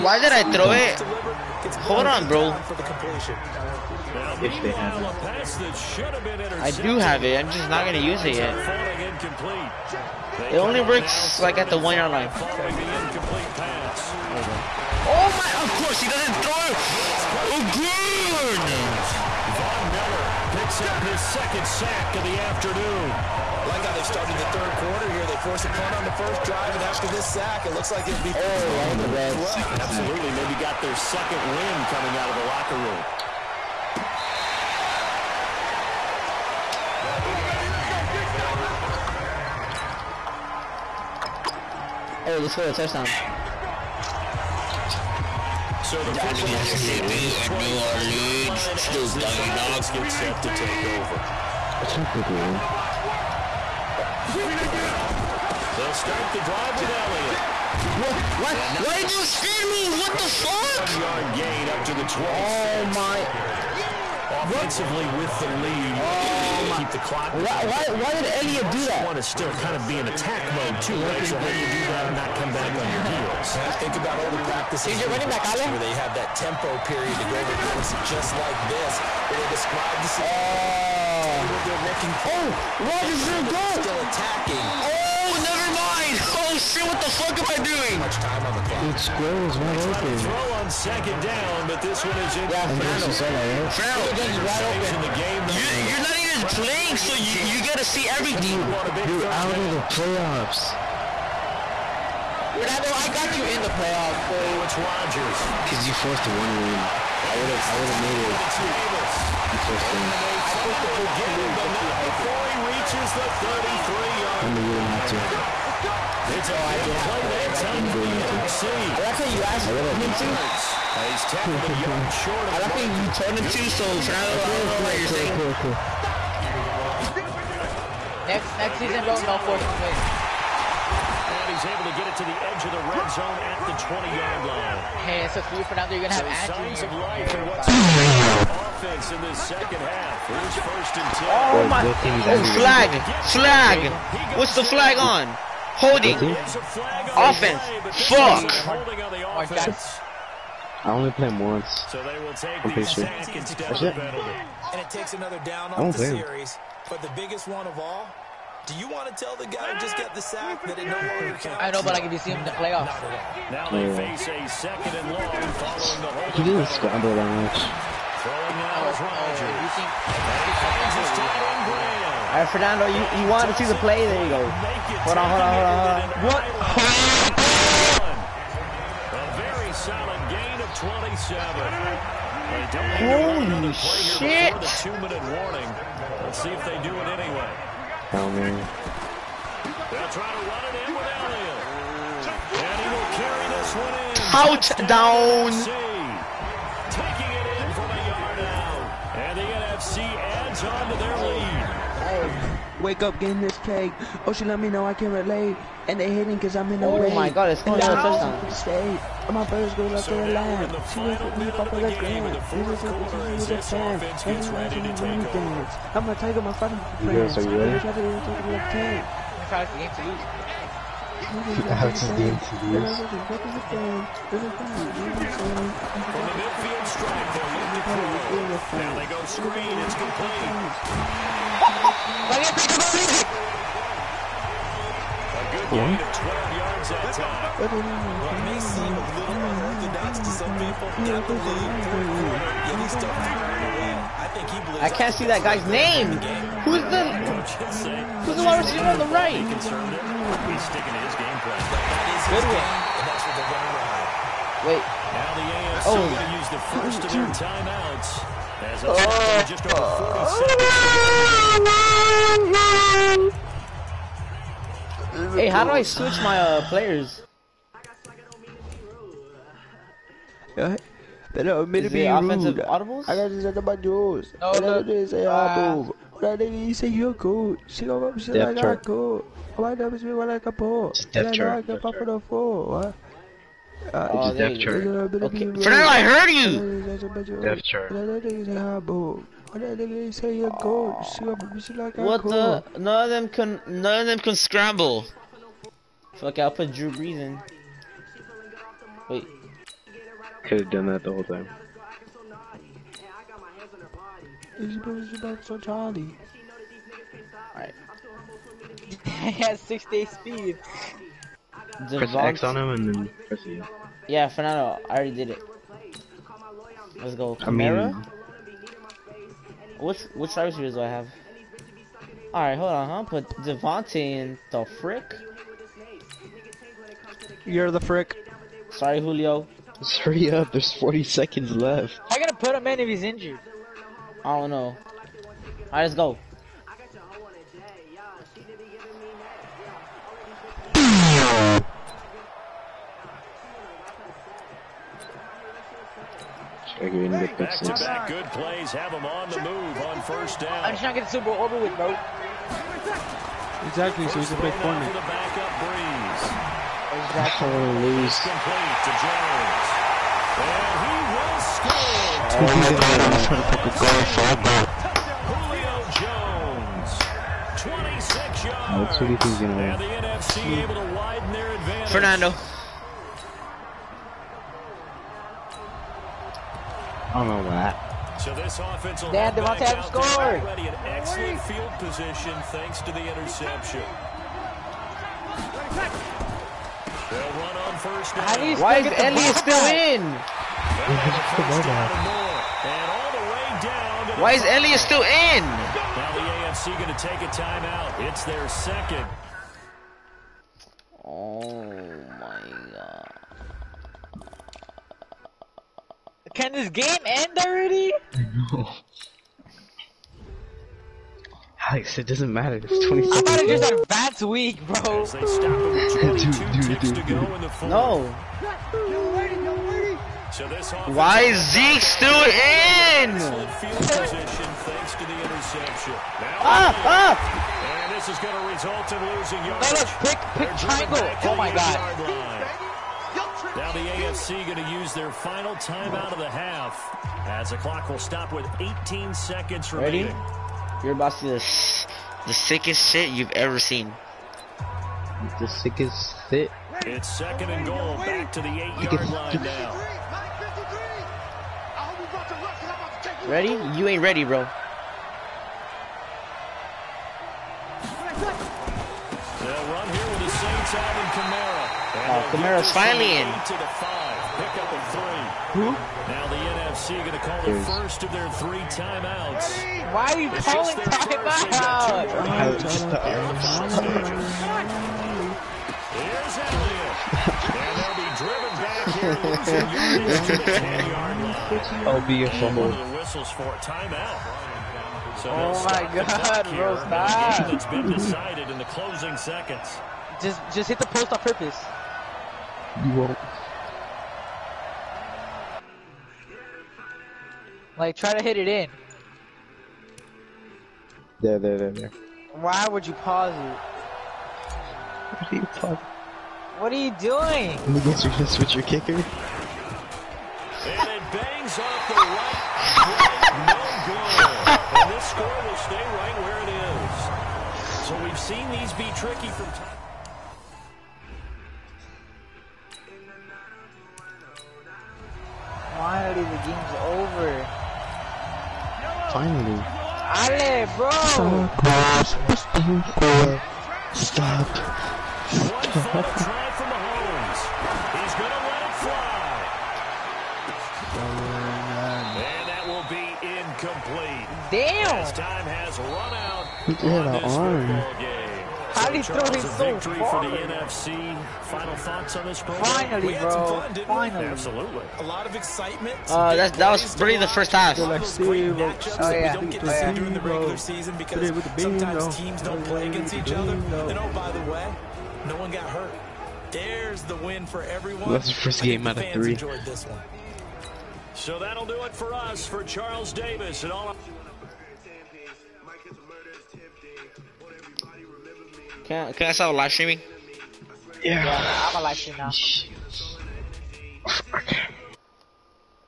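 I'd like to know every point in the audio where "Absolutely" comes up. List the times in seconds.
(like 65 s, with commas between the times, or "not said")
29 s, 554 s.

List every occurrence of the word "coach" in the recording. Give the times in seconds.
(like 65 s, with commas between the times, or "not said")
110 s.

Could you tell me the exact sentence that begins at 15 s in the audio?
Oh my, of course he doesn't throw it!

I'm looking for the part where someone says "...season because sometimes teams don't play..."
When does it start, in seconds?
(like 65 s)
560 s.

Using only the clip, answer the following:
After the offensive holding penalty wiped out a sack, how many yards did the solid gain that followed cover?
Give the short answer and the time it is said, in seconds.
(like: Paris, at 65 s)
27, at 180 s.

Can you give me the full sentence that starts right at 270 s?
They don't mean to be rude.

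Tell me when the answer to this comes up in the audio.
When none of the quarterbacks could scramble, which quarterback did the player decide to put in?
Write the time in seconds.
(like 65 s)
296 s.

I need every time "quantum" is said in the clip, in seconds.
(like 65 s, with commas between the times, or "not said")
not said.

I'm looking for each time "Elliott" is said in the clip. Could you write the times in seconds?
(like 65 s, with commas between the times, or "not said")
68 s, 191 s, 388 s, 394 s, 479 s.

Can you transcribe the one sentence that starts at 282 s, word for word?
Uh, oh, it's a death chart.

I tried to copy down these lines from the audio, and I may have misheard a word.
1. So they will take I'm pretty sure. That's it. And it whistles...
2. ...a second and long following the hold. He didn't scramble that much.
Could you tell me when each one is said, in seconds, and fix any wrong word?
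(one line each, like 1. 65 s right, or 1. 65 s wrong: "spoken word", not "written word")
1. 151 s wrong: "takes", not "whistles"
2. 164 s right.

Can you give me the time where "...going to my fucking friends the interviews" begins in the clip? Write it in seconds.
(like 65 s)
217 s.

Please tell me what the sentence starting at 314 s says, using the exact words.
Yeah, Fernando, I already did it.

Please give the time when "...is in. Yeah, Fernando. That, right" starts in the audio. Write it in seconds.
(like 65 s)
92 s.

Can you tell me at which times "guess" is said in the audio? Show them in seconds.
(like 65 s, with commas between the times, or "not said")
507 s.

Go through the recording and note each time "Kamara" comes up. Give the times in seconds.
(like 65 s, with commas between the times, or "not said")
317 s, 462 s.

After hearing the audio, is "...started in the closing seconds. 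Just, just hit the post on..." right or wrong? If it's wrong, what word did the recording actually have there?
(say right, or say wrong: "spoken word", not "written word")
wrong: "decided", not "started".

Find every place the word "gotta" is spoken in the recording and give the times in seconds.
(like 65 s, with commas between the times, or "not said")
97 s, 332 s.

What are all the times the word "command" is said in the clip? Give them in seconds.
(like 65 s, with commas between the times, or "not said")
461 s.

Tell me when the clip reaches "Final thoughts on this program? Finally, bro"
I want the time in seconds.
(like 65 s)
551 s.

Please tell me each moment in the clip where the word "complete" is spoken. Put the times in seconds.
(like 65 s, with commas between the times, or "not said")
229 s, 357 s.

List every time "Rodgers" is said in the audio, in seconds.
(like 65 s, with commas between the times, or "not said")
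82 s, 104 s, 171 s.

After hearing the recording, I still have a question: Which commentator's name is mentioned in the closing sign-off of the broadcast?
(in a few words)
Charles Davis.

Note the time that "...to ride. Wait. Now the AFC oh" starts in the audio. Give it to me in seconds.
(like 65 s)
255 s.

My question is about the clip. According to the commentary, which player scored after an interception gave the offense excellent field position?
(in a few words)
Davante Adams.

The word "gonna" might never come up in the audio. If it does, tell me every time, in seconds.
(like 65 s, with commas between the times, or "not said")
7 s, 136 s.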